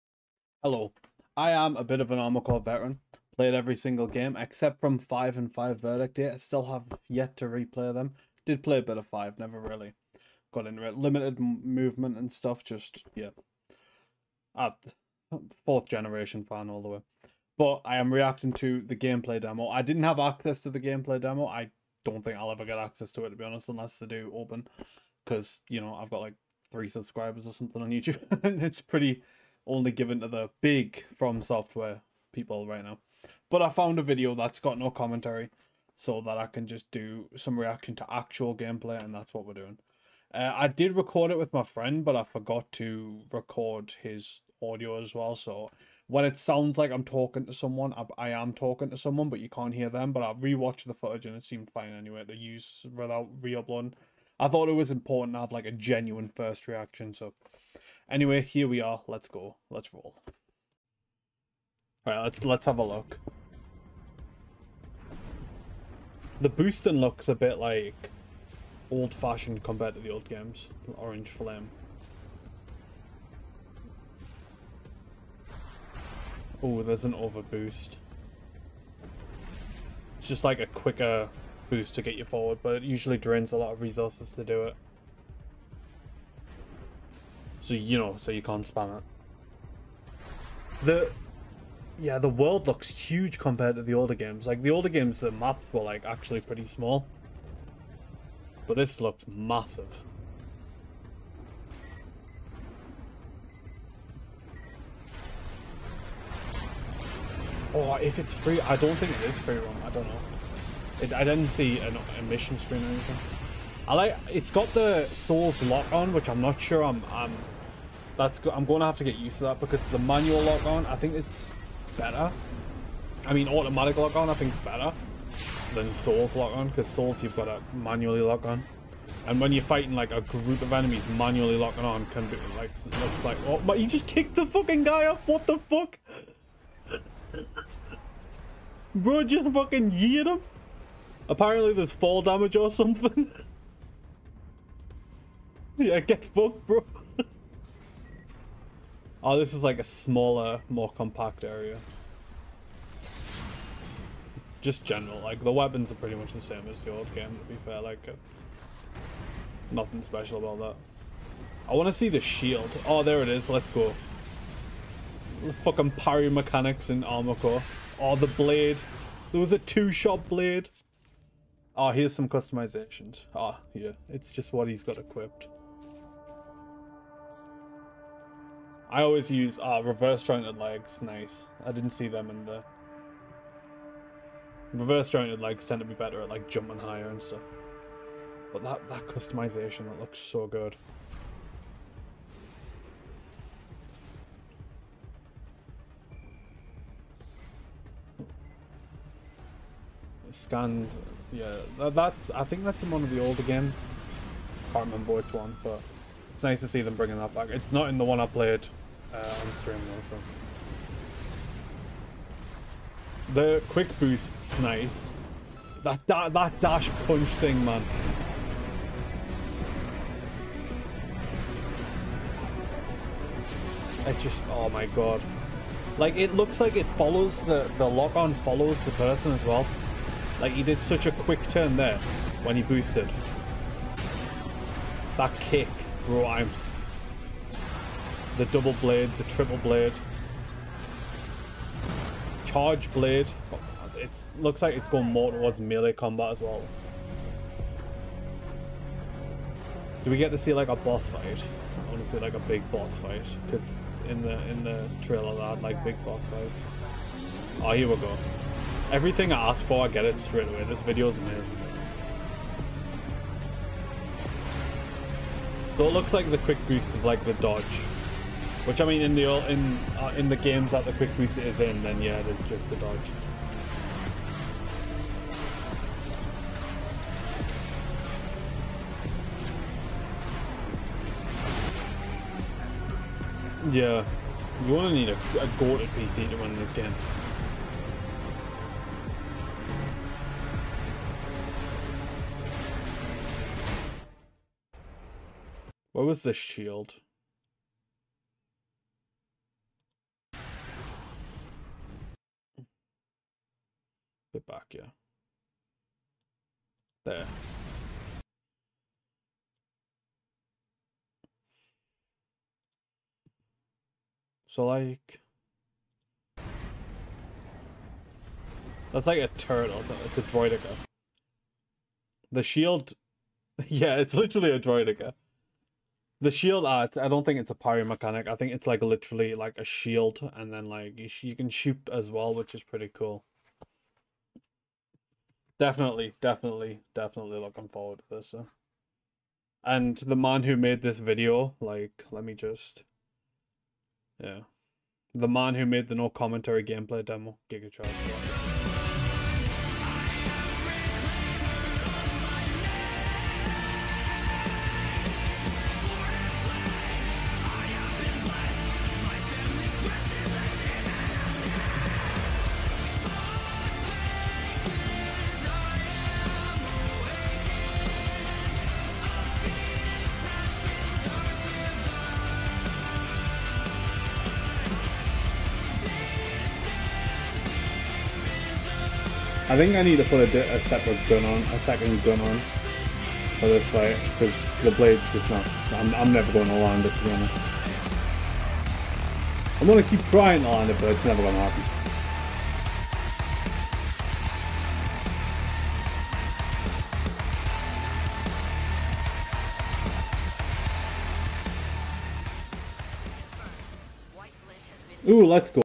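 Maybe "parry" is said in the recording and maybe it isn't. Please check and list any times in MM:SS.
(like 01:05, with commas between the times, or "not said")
02:45, 05:27.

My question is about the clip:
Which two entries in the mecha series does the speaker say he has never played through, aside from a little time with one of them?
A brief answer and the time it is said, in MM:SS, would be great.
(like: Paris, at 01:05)
5 and Verdict Day, at 00:04.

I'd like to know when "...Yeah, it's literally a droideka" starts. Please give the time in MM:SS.
05:23.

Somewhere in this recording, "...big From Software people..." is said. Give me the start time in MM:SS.
00:30.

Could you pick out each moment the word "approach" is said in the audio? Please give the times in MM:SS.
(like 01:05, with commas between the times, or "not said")
not said.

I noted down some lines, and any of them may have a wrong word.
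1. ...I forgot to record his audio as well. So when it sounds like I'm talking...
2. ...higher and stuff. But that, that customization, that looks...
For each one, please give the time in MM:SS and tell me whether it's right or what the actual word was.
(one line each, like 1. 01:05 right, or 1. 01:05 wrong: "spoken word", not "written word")
1. 00:42 right
2. 03:06 right.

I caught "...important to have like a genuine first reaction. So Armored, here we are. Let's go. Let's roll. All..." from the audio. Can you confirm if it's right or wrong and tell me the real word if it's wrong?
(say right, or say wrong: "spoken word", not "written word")
wrong: "Anyway", not "Armored".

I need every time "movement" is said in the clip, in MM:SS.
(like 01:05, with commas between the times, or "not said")
00:11.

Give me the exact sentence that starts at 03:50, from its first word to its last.
Like, he did such a quick turn there when he boosted.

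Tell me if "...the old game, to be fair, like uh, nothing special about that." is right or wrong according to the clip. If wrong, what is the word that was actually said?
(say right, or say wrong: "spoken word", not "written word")
right.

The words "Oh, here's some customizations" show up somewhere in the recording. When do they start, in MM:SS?
02:51.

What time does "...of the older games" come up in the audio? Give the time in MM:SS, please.
03:23.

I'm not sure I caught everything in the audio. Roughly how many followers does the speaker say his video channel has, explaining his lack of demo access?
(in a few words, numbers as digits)
3.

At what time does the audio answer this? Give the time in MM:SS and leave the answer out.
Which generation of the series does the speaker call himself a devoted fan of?
00:15.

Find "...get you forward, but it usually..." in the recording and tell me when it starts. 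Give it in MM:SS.
01:22.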